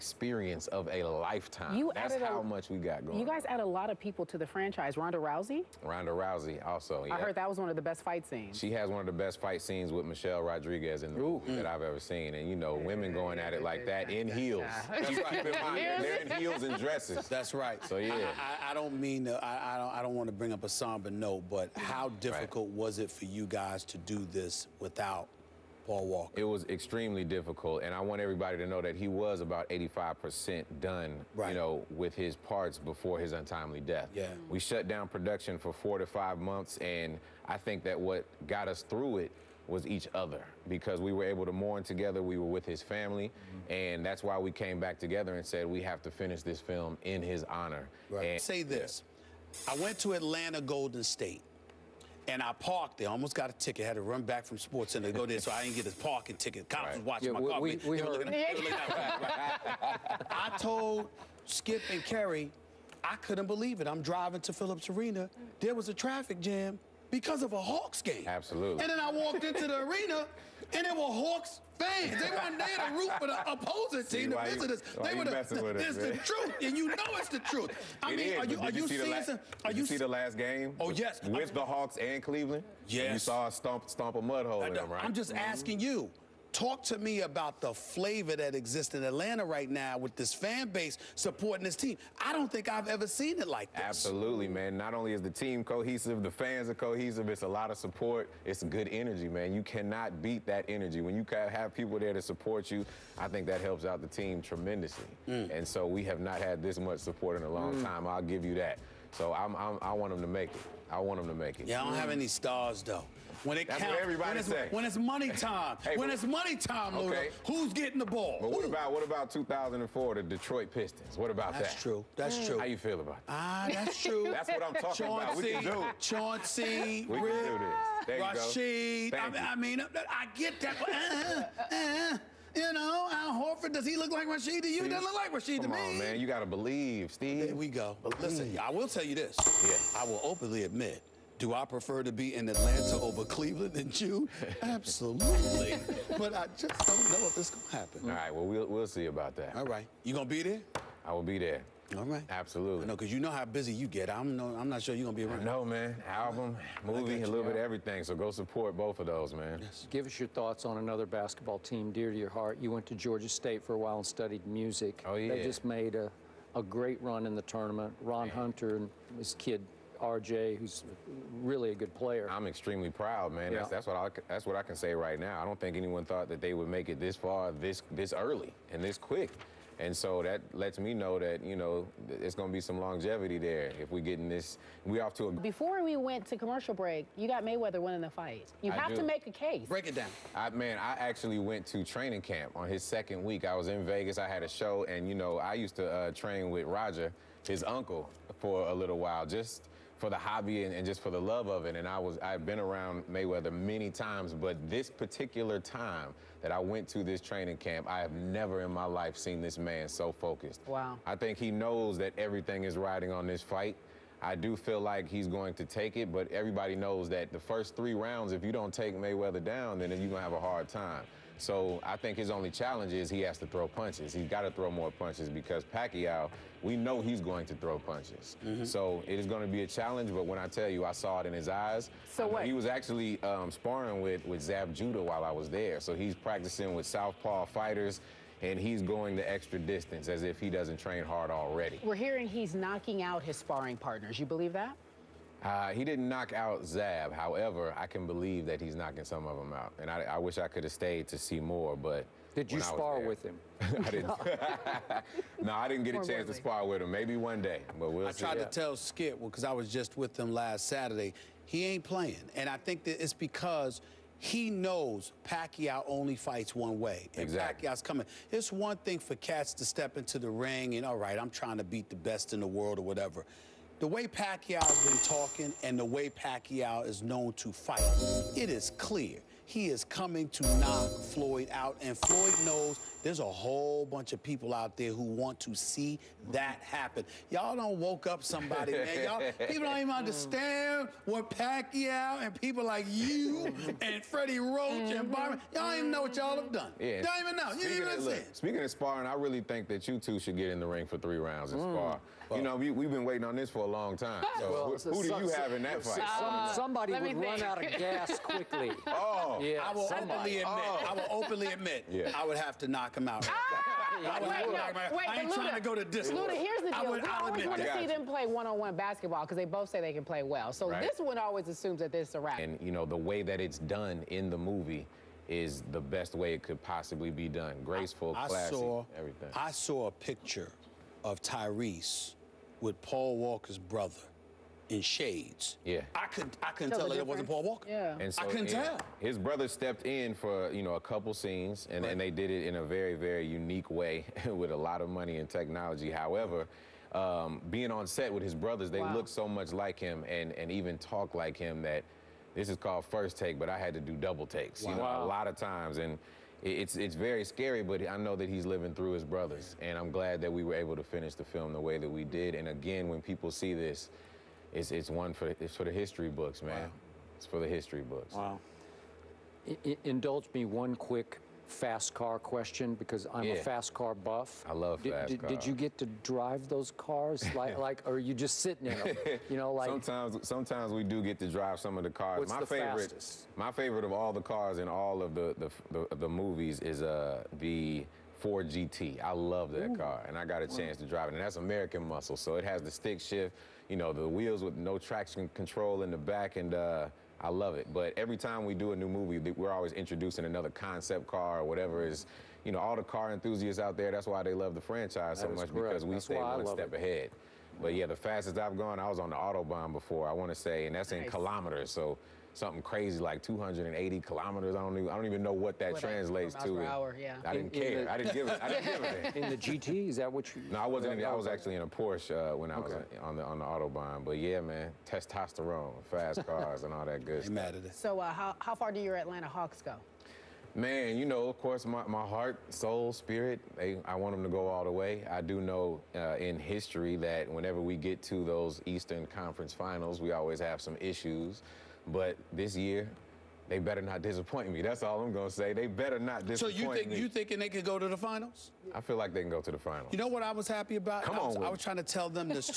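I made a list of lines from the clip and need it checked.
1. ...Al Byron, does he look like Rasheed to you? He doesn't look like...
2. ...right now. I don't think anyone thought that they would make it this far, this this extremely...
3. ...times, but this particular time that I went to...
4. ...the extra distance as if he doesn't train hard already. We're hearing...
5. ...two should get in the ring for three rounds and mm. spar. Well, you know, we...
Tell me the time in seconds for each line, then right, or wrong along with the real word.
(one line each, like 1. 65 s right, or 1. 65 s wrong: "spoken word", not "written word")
1. 133 s wrong: "Horford", not "Byron"
2. 174 s wrong: "early", not "extremely"
3. 203 s right
4. 239 s right
5. 299 s right.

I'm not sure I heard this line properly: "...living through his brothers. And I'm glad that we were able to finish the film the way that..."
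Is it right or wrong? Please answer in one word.
right.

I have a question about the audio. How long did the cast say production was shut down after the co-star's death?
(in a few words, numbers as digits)
4 to 5 months.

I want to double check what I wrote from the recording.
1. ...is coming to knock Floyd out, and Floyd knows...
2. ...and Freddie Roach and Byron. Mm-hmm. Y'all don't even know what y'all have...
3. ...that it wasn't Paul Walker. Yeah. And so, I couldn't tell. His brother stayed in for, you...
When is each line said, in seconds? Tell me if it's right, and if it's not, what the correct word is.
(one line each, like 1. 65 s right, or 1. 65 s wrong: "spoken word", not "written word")
1. 279 s right
2. 293 s right
3. 336 s wrong: "stepped", not "stayed".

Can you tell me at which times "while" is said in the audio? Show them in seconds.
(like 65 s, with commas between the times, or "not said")
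163 s, 198 s, 235 s.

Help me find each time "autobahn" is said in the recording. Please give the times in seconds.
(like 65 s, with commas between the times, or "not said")
409 s, 423 s.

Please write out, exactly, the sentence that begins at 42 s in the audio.
We were with his family, mm-hmm.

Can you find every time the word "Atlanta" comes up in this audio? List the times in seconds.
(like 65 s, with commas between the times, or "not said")
50 s, 89 s, 142 s, 428 s.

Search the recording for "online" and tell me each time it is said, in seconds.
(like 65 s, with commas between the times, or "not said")
not said.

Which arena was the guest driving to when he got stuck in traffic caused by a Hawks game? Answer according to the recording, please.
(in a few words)
Phillips Arena.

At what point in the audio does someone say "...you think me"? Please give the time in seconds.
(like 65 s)
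446 s.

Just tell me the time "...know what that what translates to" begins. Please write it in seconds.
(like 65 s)
415 s.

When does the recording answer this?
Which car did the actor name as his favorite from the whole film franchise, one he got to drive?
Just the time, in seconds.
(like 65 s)
388 s.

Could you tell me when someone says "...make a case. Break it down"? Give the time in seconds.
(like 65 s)
189 s.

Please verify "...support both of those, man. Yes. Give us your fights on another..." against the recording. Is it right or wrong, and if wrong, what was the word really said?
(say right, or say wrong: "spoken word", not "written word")
wrong: "thoughts", not "fights".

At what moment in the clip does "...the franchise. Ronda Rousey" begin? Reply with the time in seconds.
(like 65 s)
4 s.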